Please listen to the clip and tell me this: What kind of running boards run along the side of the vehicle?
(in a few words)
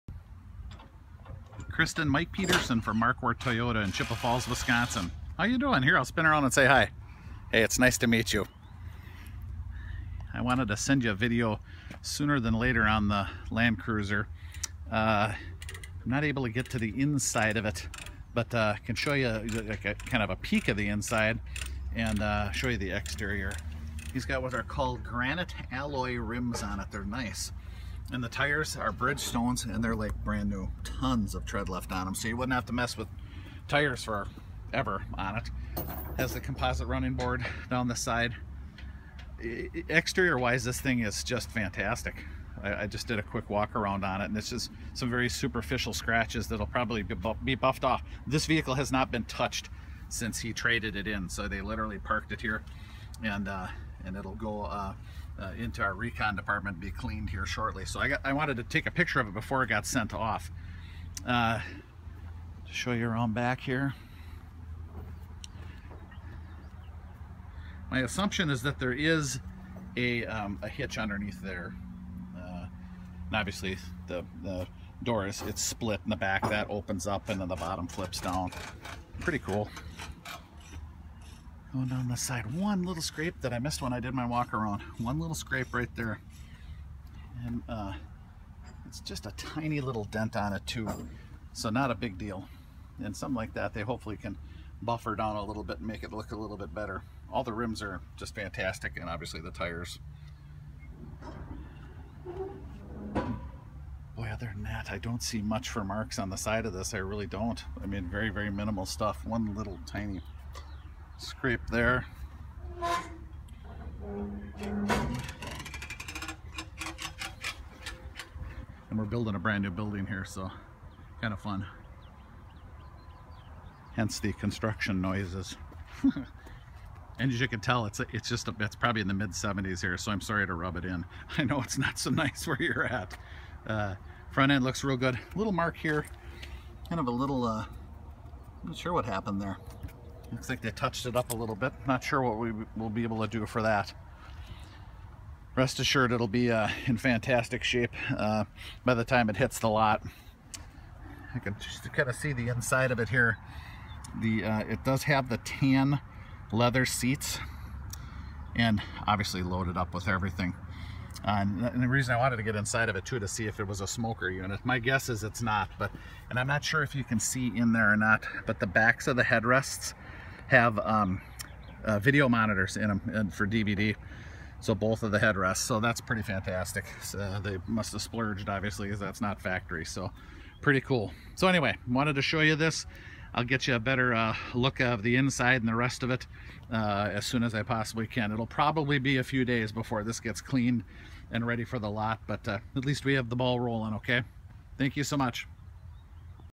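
composite.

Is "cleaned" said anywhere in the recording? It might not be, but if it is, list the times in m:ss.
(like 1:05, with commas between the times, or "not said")
0:56, 3:10.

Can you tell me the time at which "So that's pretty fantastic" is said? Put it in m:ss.
2:55.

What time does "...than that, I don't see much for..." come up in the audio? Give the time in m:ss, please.
1:44.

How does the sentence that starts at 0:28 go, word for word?
And the tires are Bridgestones and they're like brand new.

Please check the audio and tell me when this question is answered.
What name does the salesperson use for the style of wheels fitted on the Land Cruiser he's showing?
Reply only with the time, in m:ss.
0:25.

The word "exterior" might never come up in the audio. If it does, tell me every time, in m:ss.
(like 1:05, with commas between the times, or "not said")
0:22, 0:39.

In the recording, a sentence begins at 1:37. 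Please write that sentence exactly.
All the rims are just fantastic and obviously the tires.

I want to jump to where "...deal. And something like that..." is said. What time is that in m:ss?
1:32.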